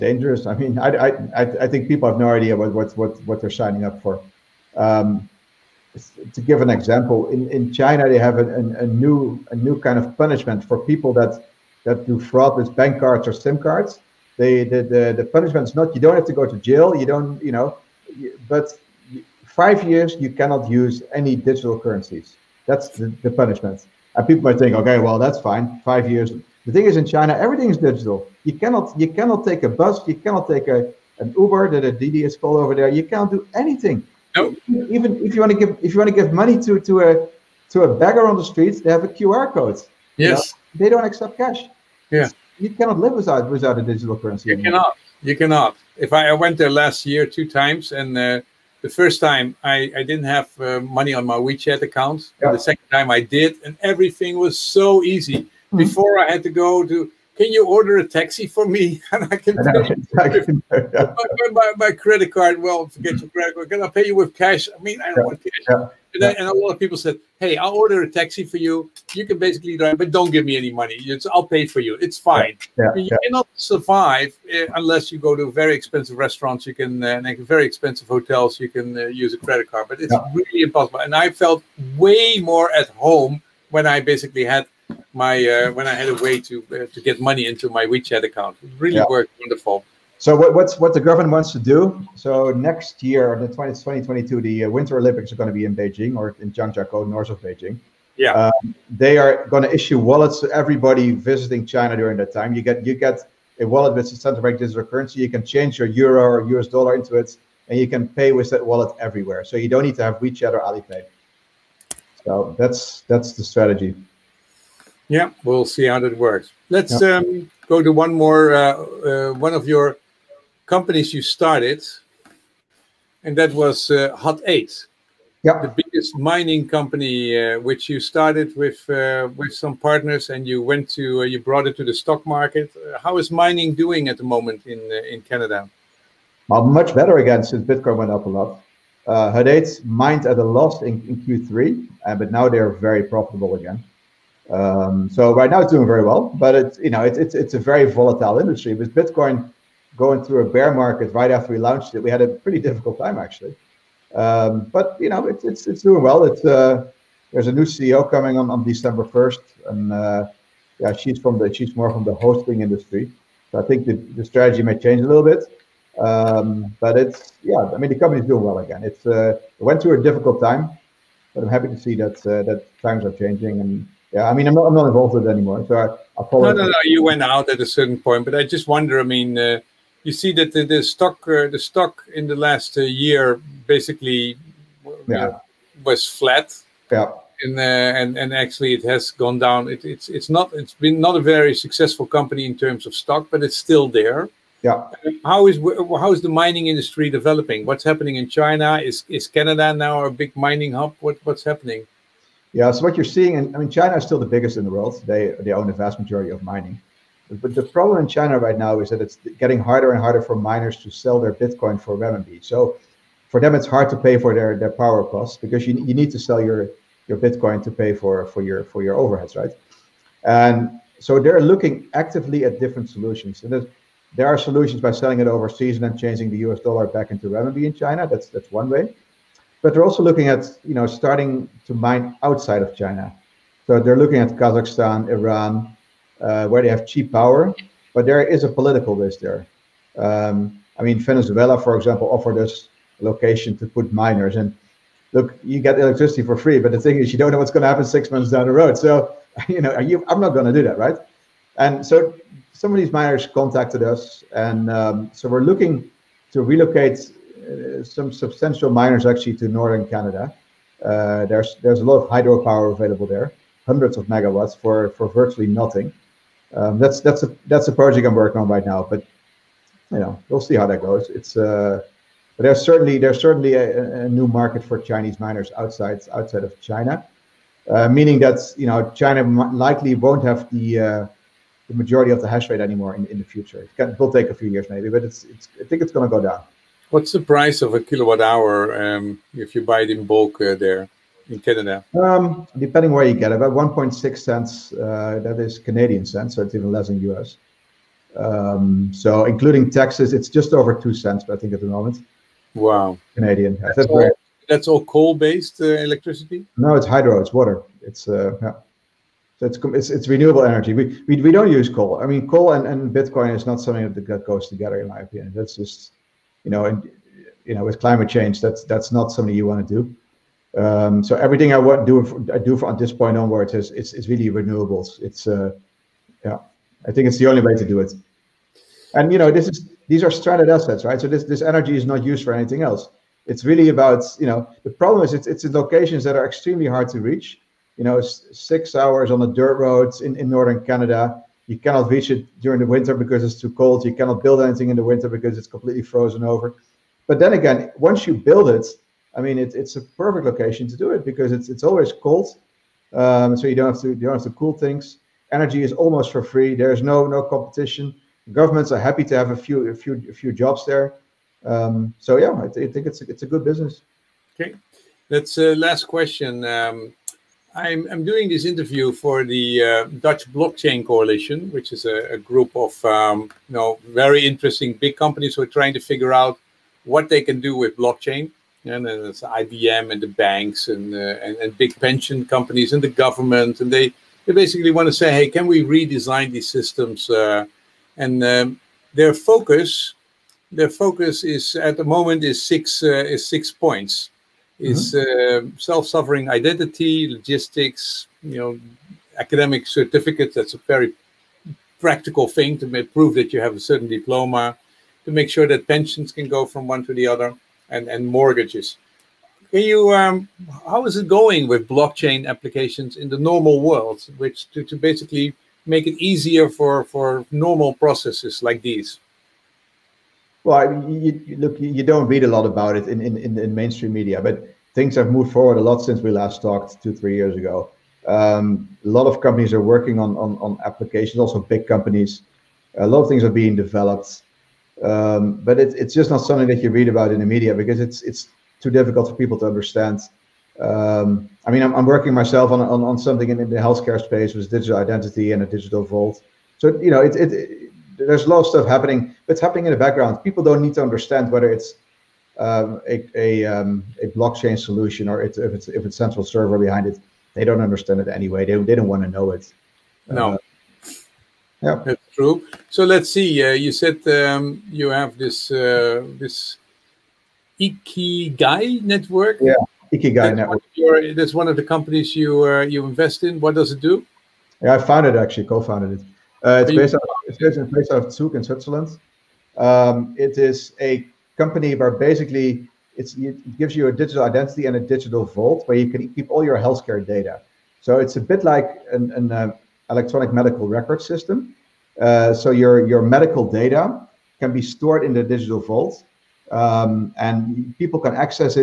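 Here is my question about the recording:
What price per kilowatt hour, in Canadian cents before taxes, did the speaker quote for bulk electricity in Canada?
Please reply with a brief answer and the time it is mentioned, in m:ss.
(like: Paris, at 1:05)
1.6 cents, at 4:53.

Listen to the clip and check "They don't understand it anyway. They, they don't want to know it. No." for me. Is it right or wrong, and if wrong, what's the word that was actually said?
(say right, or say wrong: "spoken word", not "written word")
right.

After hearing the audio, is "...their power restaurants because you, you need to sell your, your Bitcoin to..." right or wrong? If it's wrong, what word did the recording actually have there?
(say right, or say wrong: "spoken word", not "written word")
wrong: "costs", not "restaurants".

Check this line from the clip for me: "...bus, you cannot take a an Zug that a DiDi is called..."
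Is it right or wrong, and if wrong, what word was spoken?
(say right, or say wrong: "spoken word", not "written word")
wrong: "Uber", not "Zug".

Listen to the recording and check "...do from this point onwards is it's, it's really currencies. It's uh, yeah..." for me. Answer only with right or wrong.
wrong.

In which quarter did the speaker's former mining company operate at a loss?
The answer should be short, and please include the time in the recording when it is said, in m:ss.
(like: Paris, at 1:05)
Q3, at 2:21.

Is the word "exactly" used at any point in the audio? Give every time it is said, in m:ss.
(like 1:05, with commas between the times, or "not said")
not said.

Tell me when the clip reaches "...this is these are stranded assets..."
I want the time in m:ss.
5:29.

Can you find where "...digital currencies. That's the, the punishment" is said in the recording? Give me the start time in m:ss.
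0:21.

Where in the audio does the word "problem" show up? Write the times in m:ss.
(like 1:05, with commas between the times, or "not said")
3:27, 5:34.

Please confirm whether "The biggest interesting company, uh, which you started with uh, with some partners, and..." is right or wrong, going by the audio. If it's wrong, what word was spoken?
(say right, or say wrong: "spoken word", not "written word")
wrong: "mining", not "interesting".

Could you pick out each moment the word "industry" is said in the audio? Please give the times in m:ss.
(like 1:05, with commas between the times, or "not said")
2:28, 2:42, 3:16.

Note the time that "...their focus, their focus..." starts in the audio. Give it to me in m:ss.
6:28.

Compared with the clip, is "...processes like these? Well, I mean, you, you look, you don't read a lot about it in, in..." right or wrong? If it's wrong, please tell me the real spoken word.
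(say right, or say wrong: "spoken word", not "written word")
right.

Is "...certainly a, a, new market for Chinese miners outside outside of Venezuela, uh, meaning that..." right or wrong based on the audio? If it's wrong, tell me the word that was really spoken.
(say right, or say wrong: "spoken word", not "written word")
wrong: "China", not "Venezuela".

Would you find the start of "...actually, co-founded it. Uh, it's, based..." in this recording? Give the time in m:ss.
7:55.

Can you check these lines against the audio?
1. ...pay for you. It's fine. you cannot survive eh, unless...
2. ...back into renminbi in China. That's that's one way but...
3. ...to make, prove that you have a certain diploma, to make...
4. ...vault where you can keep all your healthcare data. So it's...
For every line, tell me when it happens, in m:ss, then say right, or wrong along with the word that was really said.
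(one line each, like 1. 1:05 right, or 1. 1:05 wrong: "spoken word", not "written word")
1. 1:11 right
2. 3:46 right
3. 6:42 right
4. 8:05 right.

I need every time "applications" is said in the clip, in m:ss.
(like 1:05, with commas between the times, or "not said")
6:52, 7:10.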